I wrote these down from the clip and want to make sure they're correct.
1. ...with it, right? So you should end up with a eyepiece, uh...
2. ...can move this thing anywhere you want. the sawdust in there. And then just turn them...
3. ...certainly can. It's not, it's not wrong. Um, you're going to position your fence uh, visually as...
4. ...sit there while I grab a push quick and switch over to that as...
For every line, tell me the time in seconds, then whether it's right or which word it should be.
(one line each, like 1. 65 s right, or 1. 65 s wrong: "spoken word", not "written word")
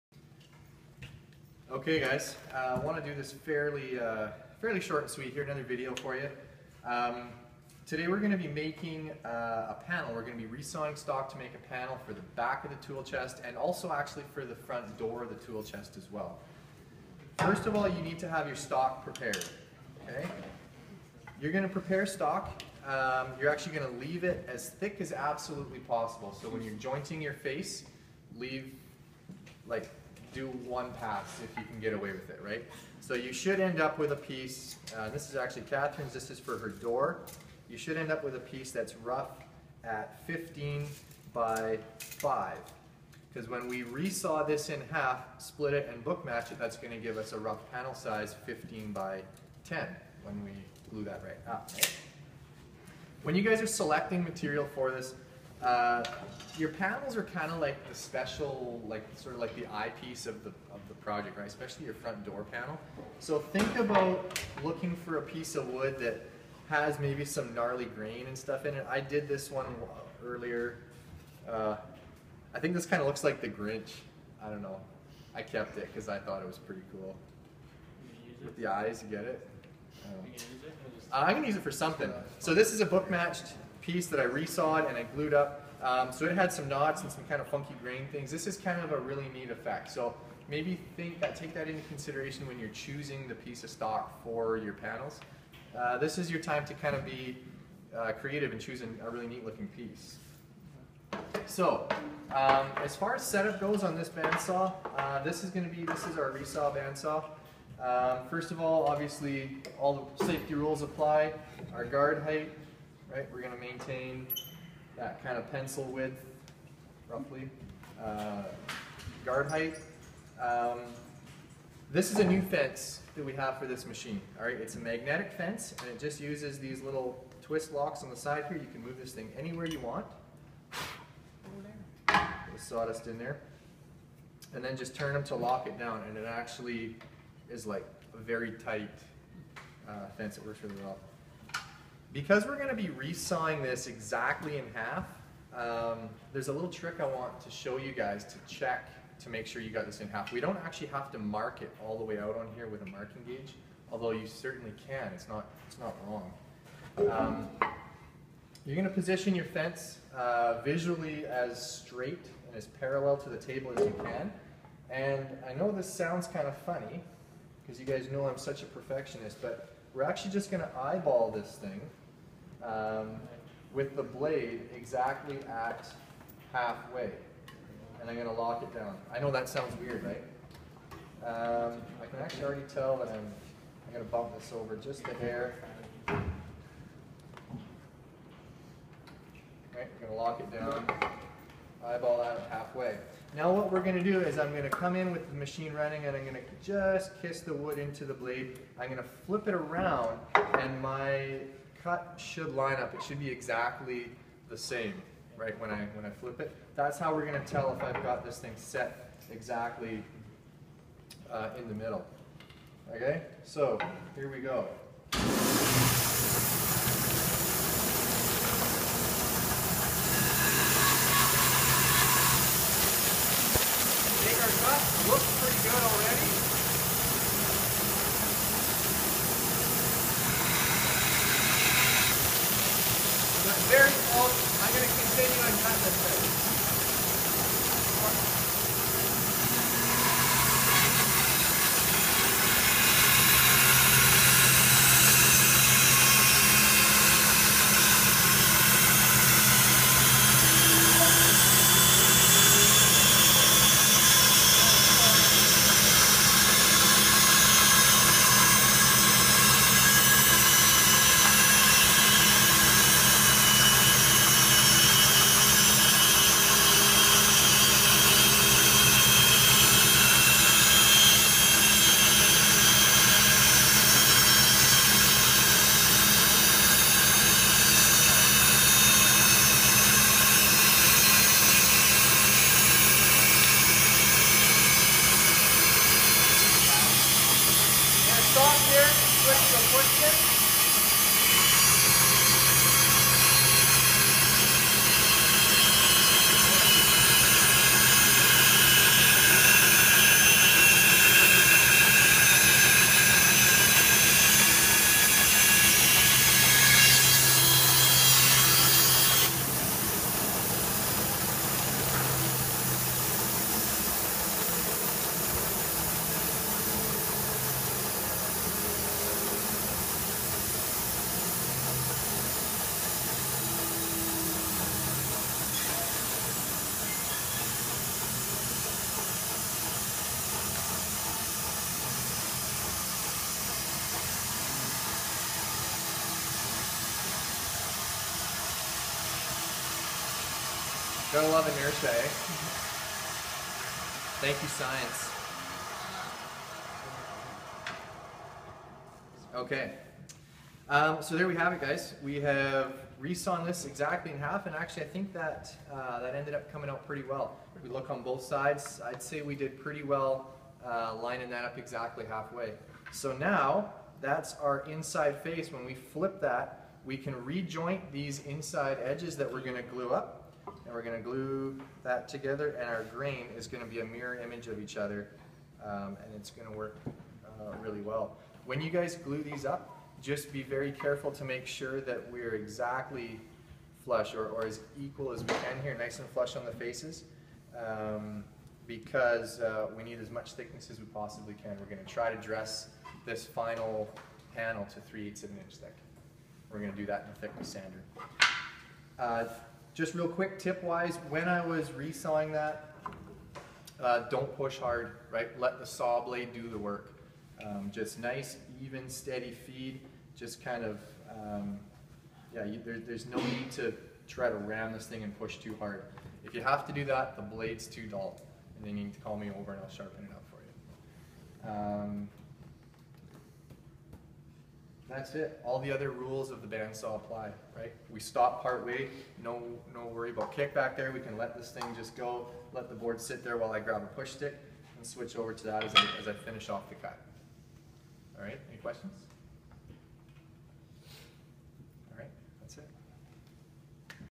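1. 32 s wrong: "piece", not "eyepiece"
2. 128 s right
3. 154 s right
4. 432 s wrong: "stick", not "quick".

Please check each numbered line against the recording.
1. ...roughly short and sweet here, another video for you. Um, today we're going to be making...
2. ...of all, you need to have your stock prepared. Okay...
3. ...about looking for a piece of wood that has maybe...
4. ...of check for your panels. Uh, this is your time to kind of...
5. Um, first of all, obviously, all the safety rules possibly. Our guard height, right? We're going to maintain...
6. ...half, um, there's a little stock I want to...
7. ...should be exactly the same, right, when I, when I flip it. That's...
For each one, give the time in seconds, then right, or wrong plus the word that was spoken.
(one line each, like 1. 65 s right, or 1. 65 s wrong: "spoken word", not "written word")
1. 4 s wrong: "fairly", not "roughly"
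2. 17 s right
3. 63 s right
4. 93 s wrong: "stock", not "check"
5. 107 s wrong: "apply", not "possibly"
6. 144 s wrong: "trick", not "stock"
7. 203 s right.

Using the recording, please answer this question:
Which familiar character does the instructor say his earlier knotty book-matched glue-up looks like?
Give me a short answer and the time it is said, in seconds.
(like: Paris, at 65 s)
The Grinch, at 73 s.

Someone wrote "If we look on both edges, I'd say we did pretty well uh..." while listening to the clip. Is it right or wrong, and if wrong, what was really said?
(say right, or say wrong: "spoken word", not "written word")
wrong: "sides", not "edges".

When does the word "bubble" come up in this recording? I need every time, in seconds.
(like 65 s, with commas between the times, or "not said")
not said.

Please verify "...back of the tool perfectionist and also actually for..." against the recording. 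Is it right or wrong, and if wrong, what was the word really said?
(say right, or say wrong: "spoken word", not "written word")
wrong: "chest", not "perfectionist".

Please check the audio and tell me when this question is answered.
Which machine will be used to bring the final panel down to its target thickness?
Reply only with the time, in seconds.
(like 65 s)
397 s.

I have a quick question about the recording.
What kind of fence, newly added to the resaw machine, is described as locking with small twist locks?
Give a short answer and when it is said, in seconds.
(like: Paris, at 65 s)
Magnetic fence, at 124 s.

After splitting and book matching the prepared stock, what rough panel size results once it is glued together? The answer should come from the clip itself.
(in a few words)
15 by 10.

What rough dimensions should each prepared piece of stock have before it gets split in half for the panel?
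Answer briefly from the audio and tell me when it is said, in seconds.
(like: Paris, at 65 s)
15 by 5, at 40 s.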